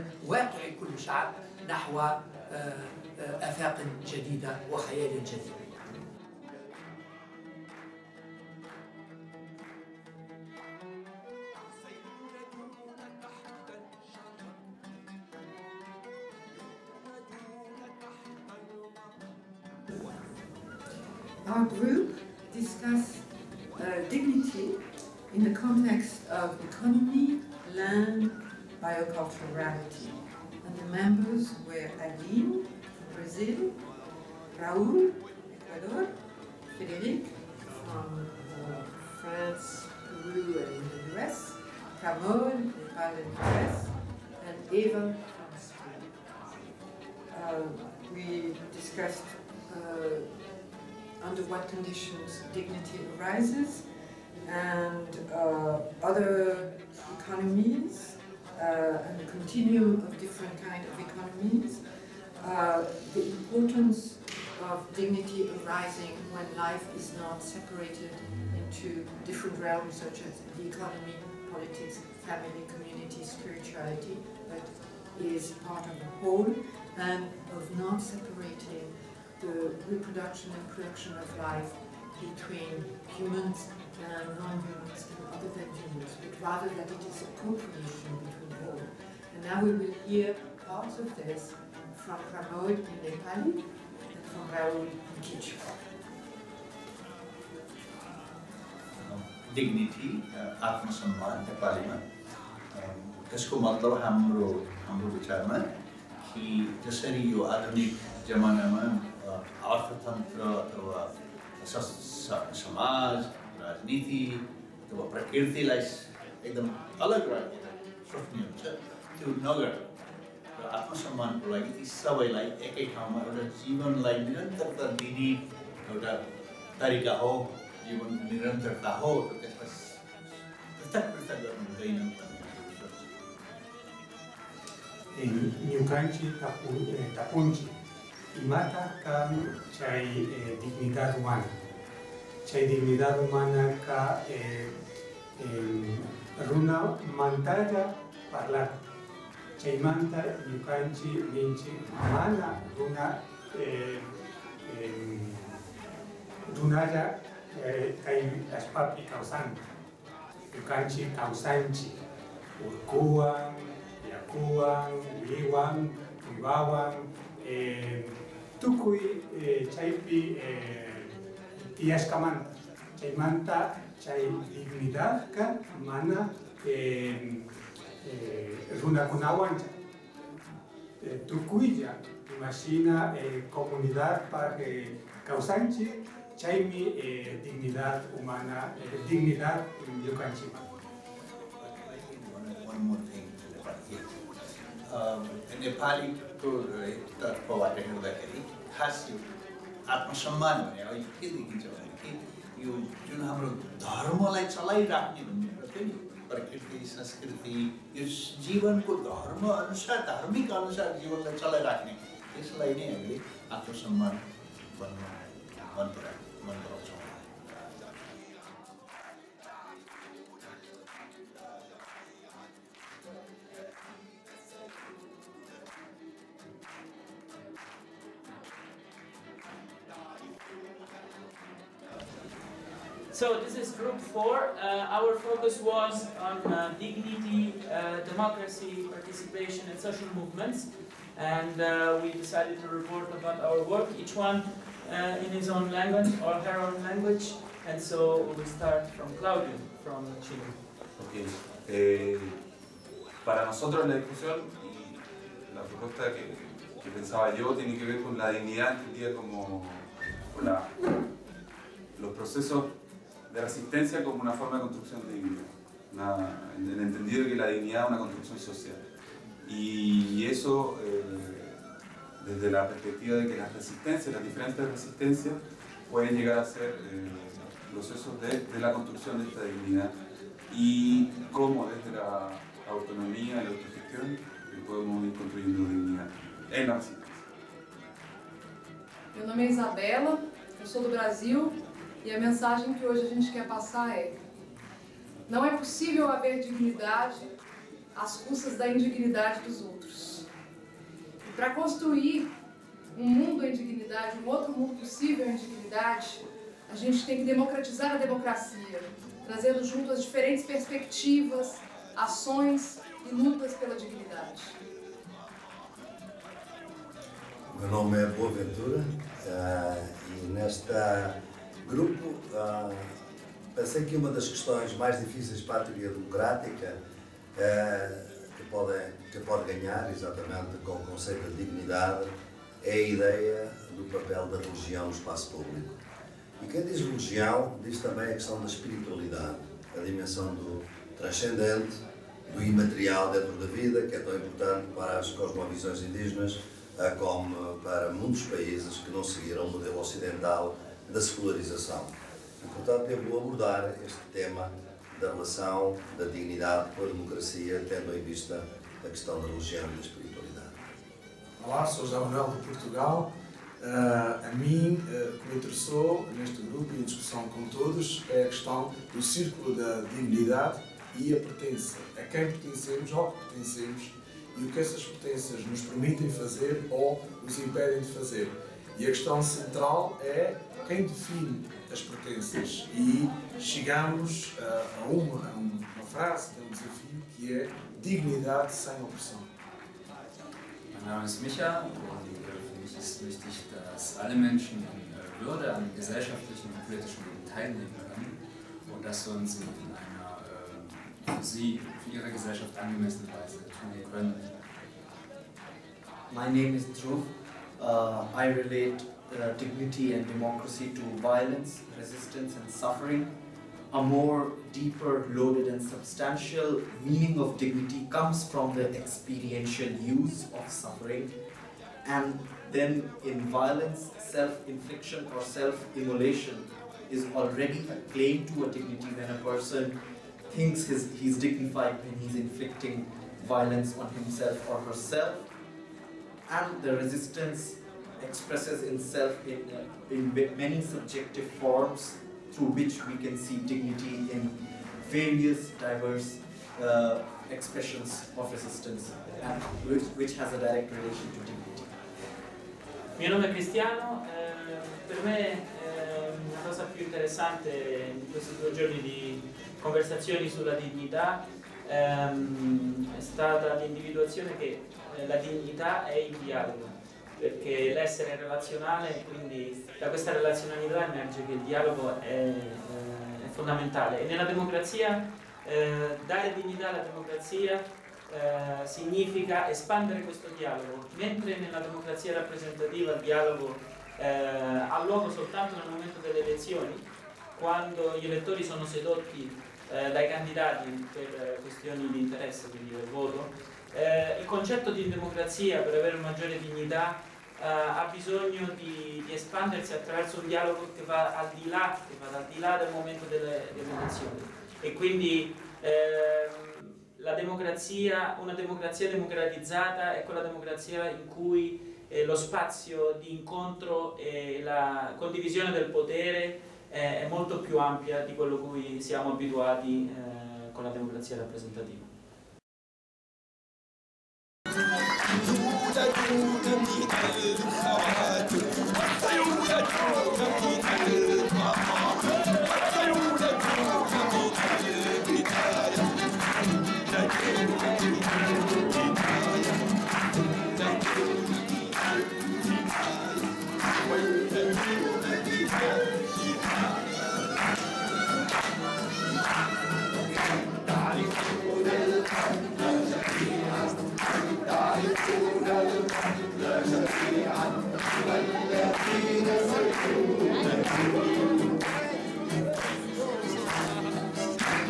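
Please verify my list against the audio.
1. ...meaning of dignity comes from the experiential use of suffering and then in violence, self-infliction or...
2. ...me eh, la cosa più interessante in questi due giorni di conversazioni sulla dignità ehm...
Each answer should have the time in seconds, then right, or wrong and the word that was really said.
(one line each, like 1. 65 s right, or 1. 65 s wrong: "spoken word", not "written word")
1. 416 s right
2. 455 s right.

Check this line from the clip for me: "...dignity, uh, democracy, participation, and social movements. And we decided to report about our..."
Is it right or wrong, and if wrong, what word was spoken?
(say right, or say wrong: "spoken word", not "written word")
right.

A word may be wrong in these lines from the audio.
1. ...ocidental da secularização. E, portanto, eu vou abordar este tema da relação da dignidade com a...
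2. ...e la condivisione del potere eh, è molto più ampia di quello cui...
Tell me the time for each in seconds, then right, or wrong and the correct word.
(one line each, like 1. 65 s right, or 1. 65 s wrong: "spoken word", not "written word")
1. 349 s right
2. 513 s right.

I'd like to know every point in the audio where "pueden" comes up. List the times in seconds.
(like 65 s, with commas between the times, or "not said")
275 s.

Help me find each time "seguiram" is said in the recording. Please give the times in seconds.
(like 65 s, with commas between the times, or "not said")
349 s.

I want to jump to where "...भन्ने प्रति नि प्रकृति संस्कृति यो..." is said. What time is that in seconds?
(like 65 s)
205 s.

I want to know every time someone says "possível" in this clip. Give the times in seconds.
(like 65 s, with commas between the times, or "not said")
295 s, 304 s.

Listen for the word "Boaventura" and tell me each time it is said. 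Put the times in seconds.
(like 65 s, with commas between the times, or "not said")
318 s.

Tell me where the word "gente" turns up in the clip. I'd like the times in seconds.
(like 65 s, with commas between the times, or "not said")
293 s, 306 s.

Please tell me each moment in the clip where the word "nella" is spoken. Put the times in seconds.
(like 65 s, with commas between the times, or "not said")
474 s, 481 s.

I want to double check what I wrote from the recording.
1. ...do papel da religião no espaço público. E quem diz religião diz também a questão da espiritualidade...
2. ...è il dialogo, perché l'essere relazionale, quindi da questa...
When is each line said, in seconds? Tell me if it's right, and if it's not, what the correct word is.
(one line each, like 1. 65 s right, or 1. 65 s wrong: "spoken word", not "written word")
1. 333 s right
2. 465 s right.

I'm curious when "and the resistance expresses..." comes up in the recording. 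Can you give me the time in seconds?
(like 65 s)
436 s.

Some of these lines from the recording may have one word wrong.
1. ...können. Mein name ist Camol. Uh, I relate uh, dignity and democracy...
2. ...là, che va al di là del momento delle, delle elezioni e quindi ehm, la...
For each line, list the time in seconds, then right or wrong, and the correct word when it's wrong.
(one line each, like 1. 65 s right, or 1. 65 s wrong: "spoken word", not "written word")
1. 403 s wrong: "Dhruv", not "Camol"
2. 501 s right.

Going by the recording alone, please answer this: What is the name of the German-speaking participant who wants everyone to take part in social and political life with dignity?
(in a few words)
Micha.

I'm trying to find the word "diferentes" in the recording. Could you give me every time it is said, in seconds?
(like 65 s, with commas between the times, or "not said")
274 s, 310 s.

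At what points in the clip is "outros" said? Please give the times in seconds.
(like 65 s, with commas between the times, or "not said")
299 s, 304 s.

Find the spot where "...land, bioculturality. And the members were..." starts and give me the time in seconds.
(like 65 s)
27 s.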